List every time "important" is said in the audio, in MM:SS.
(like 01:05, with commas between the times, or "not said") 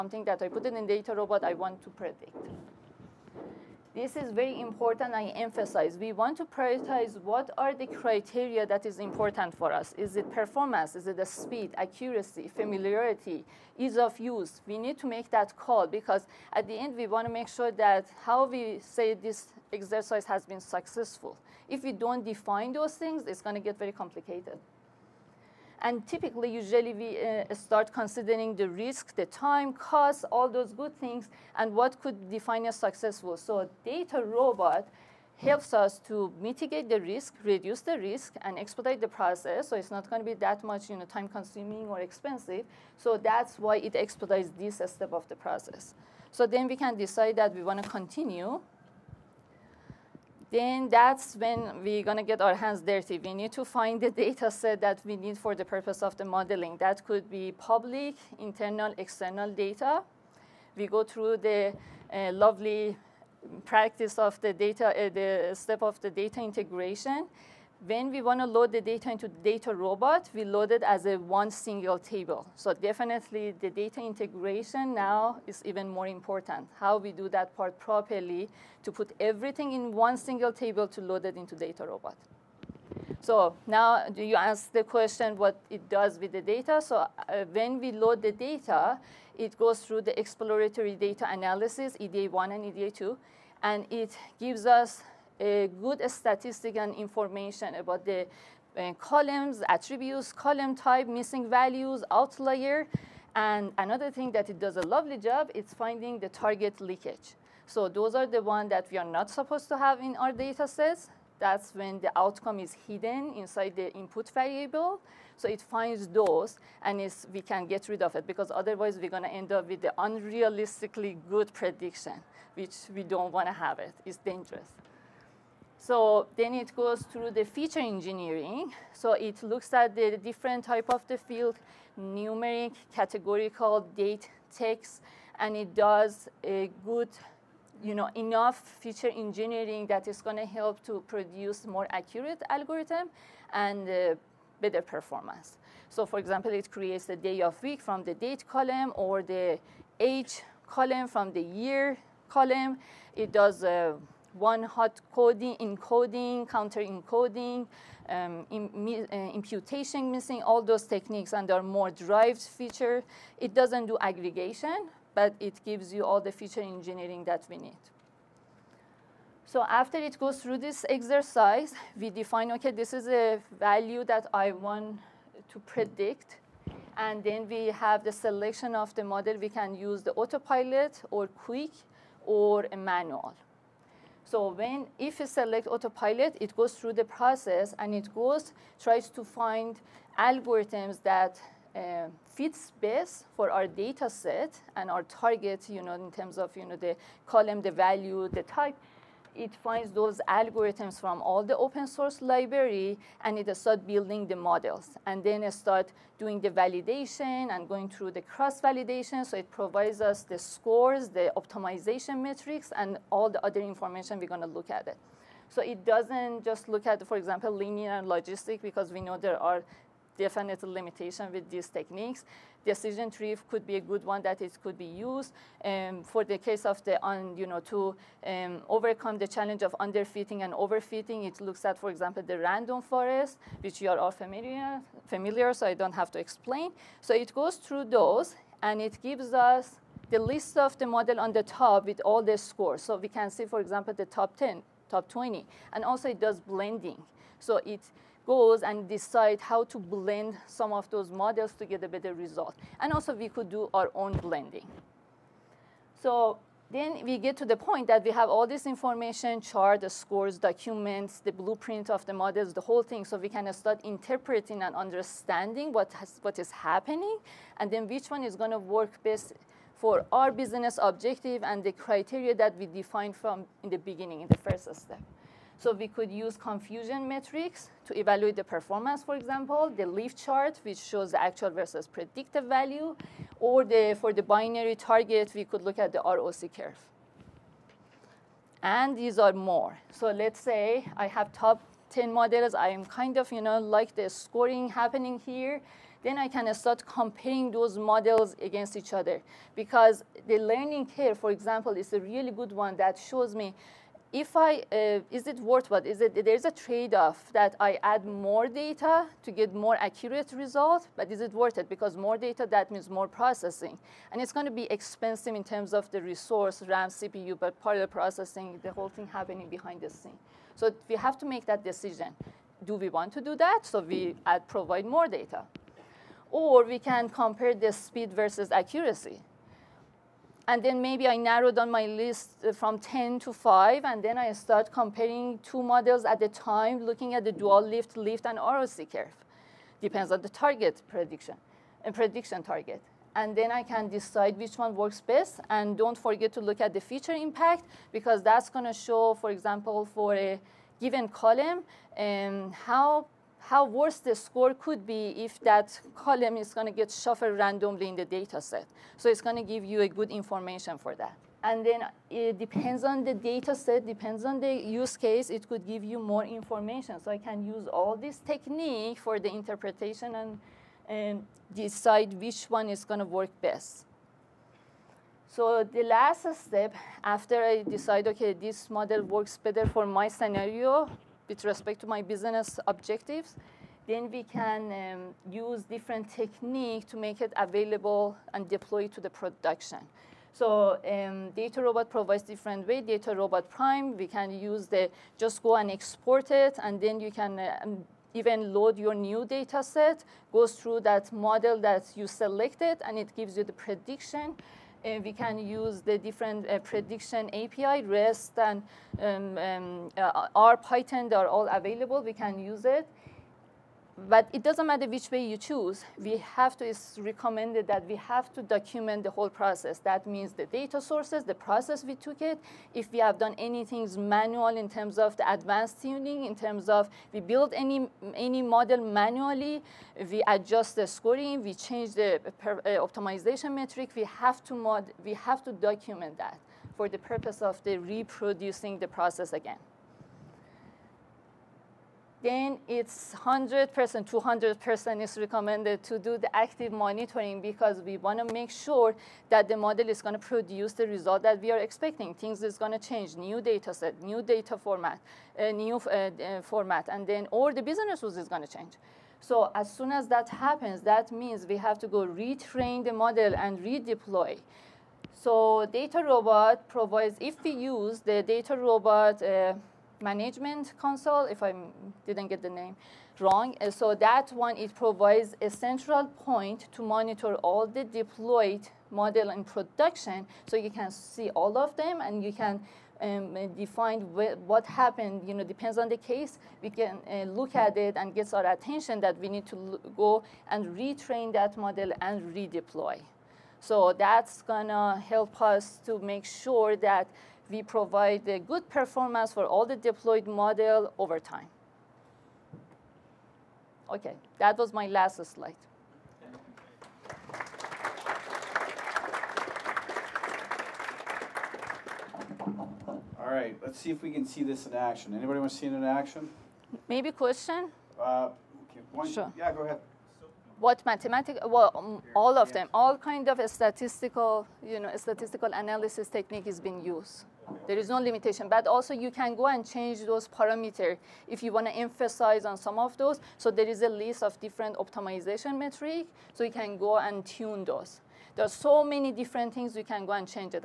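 00:04, 00:08, 01:16.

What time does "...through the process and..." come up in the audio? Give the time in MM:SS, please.
03:06.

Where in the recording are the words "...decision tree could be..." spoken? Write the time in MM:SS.
03:42.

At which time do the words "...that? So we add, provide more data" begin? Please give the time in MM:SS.
05:23.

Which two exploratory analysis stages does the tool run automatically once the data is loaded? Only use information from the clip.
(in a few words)
EDA1 and EDA2.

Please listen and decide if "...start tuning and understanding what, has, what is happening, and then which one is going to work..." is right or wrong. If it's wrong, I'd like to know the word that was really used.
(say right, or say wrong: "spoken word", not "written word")
wrong: "interpreting", not "tuning".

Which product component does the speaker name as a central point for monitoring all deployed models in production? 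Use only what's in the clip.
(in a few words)
Management console.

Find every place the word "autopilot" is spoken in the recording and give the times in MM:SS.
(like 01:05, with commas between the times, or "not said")
03:00, 03:05.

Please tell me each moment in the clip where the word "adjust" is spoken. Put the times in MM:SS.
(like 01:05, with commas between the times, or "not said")
07:10.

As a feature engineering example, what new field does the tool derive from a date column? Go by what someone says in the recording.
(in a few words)
Day of week.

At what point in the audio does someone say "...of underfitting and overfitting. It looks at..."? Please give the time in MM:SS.
03:49.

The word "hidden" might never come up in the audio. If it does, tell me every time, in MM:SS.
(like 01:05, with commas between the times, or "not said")
01:52.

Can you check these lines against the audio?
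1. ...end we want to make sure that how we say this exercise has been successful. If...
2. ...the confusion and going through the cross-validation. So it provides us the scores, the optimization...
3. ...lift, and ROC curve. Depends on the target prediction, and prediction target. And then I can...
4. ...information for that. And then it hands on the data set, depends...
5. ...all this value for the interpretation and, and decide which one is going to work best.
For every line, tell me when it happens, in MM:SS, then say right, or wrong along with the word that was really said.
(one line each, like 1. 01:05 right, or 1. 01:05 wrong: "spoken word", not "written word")
1. 00:16 right
2. 03:26 wrong: "validation", not "confusion"
3. 05:37 right
4. 06:00 wrong: "depends", not "hands"
5. 06:07 wrong: "technique", not "value".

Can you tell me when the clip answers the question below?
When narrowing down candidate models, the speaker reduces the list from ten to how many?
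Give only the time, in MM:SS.
05:33.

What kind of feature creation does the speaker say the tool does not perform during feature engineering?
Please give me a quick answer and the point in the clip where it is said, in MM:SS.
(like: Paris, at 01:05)
Aggregation, at 02:44.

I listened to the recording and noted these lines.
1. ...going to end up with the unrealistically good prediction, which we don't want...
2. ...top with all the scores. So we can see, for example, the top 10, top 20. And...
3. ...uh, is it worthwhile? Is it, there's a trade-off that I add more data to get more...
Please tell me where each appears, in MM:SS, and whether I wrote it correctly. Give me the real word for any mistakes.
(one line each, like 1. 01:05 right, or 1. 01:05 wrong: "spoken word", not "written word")
1. 01:59 right
2. 04:01 right
3. 05:04 right.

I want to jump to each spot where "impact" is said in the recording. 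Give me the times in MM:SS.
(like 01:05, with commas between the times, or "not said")
05:47.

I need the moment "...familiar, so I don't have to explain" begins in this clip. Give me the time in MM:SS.
03:55.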